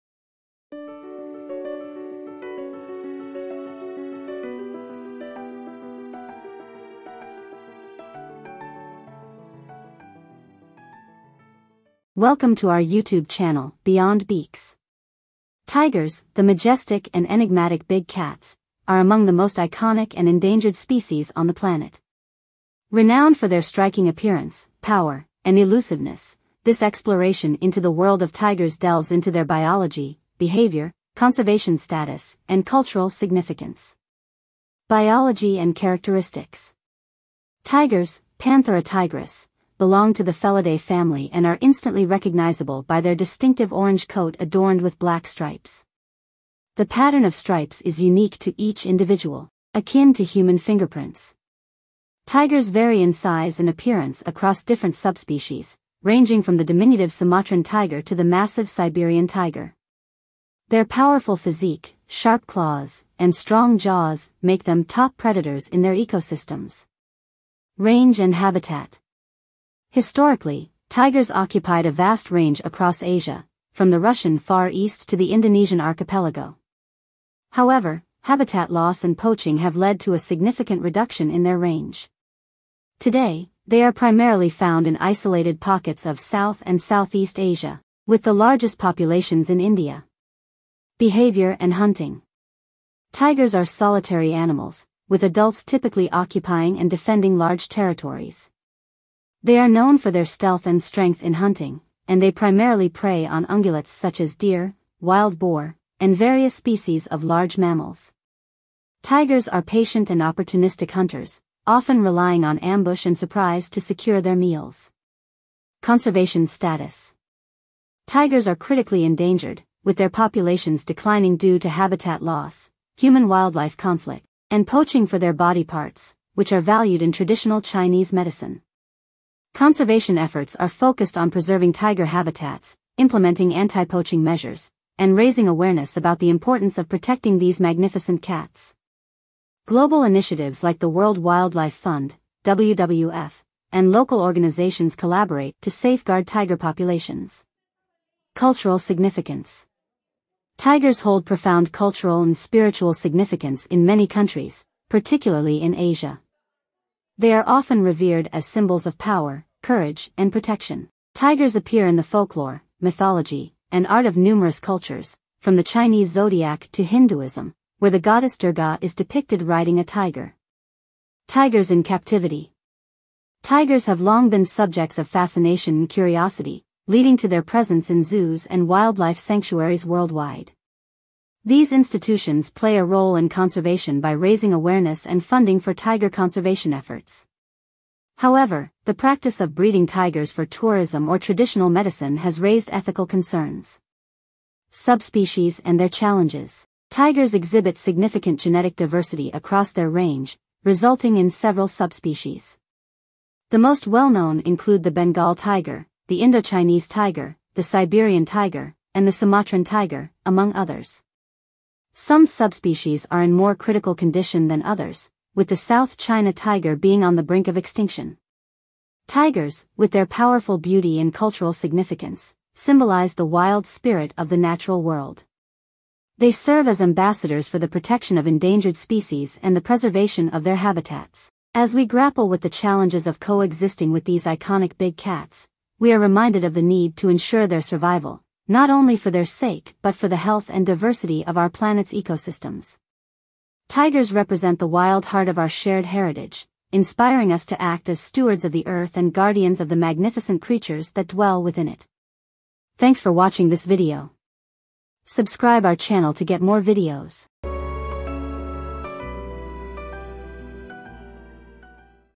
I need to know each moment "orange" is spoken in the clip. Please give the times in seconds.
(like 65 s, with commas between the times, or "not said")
43 s.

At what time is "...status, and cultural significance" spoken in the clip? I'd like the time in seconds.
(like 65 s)
31 s.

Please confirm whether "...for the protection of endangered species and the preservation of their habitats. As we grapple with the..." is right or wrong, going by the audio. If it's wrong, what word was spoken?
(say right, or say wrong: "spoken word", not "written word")
right.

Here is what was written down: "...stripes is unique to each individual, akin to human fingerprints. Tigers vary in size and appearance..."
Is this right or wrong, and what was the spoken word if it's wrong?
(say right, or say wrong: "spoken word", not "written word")
right.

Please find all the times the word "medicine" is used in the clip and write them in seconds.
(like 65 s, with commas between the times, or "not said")
128 s, 191 s.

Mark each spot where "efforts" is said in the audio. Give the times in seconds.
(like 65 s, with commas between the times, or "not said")
130 s, 186 s.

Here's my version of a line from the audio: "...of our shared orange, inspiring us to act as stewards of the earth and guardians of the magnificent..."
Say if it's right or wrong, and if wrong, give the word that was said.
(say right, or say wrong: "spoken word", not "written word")
wrong: "heritage", not "orange".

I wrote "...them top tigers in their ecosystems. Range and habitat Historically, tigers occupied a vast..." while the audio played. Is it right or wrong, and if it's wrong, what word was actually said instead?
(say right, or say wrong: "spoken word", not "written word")
wrong: "predators", not "tigers".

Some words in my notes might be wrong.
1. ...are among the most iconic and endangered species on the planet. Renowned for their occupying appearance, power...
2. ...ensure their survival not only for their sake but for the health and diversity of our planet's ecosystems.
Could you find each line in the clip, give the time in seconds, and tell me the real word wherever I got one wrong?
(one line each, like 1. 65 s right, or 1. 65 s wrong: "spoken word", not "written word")
1. 18 s wrong: "striking", not "occupying"
2. 237 s right.